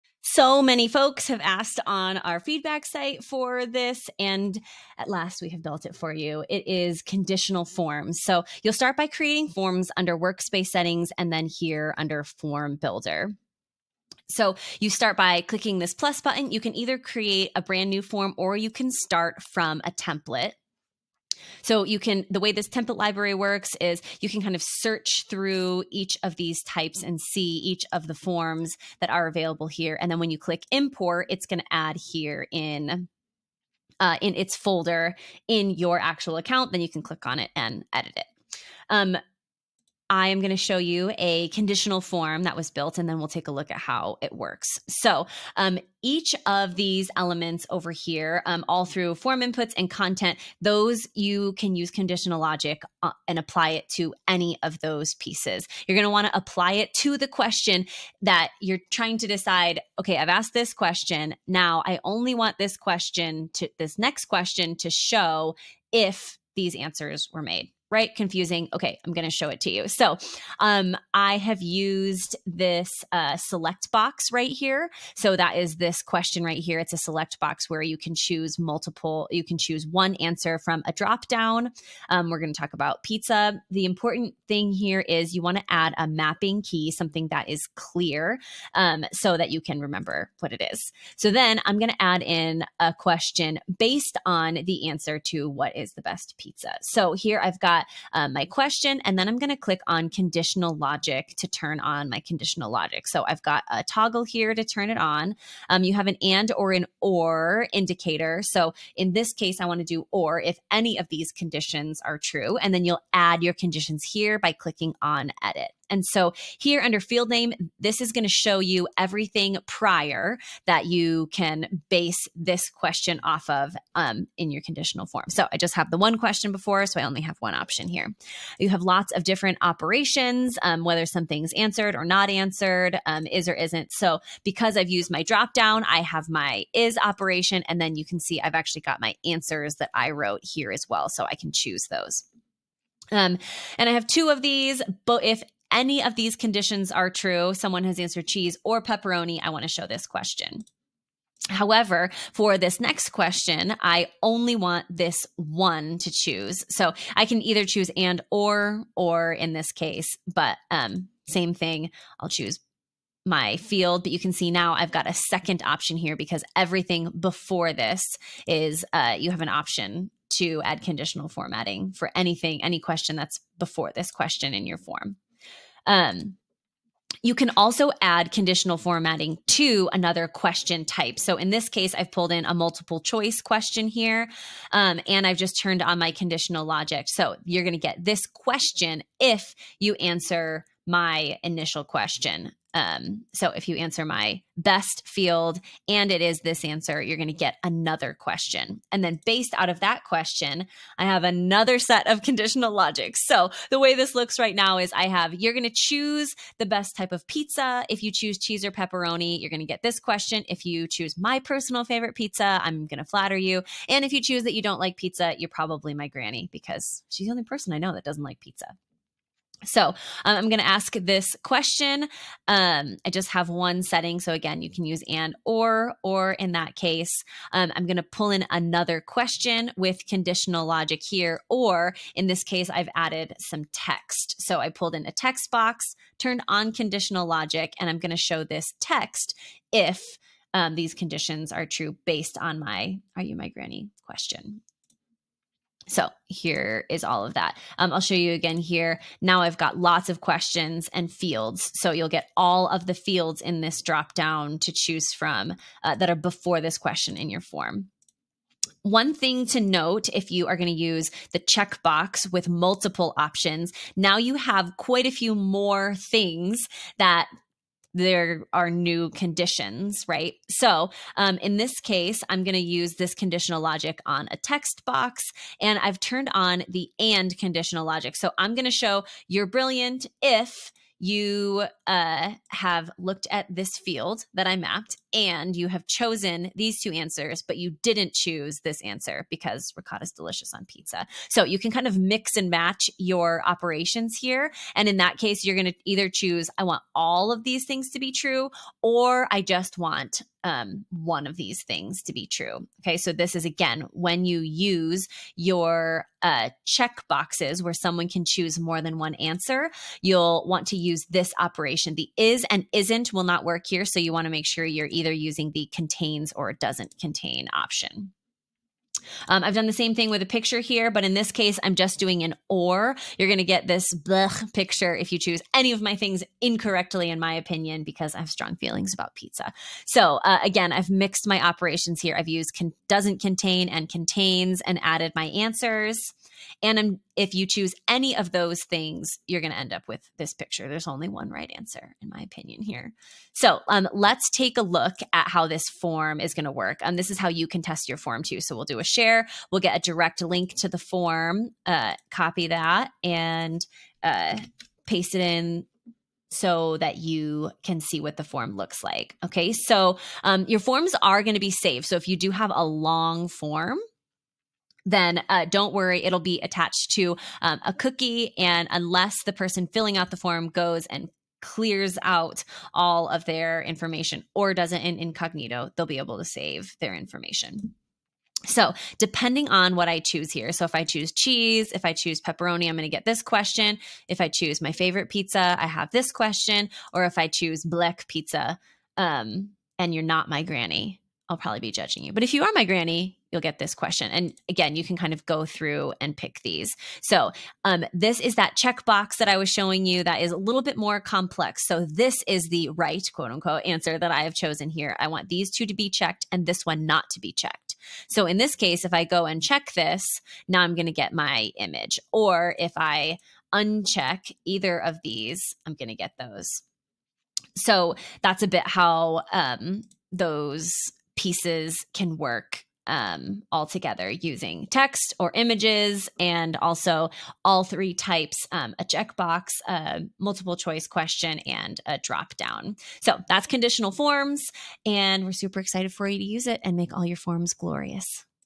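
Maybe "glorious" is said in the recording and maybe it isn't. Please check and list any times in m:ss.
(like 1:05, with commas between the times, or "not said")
7:17.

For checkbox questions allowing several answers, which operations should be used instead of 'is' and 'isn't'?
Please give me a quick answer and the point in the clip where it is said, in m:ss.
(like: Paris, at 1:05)
Contains or doesn't contain, at 5:15.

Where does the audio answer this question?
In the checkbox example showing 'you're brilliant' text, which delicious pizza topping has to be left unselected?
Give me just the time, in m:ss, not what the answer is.
4:49.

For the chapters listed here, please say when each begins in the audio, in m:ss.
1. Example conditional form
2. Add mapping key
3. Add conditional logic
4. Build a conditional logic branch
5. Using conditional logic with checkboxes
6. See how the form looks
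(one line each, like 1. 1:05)
1. 0:48
2. 1:20
3. 1:37
4. 2:57
5. 4:20
6. 5:43.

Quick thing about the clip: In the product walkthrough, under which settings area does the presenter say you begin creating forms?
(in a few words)
Workspace settings.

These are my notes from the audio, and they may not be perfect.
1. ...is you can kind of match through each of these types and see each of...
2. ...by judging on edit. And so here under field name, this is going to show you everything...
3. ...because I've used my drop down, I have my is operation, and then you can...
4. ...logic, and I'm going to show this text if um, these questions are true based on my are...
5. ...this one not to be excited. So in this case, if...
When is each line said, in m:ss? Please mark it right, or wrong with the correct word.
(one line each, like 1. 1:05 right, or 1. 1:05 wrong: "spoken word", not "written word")
1. 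0:23 wrong: "search", not "match"
2. 1:54 wrong: "clicking", not "judging"
3. 2:14 right
4. 3:57 wrong: "conditions", not "questions"
5. 6:46 wrong: "checked", not "excited".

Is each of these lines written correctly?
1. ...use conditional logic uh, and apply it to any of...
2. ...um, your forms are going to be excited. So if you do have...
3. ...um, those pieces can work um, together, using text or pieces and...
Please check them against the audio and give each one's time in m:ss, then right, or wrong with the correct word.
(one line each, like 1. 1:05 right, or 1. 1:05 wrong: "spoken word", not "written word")
1. 0:51 right
2. 6:00 wrong: "saved", not "excited"
3. 6:59 wrong: "images", not "pieces".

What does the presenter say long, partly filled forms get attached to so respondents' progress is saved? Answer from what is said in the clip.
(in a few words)
A cookie.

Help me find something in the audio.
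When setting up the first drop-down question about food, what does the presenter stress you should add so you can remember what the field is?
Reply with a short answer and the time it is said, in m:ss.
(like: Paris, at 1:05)
A mapping key, at 1:26.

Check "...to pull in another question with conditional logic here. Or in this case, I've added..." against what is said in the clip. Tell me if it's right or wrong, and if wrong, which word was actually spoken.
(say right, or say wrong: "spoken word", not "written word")
right.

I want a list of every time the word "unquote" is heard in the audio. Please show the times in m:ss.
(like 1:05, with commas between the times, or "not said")
6:43.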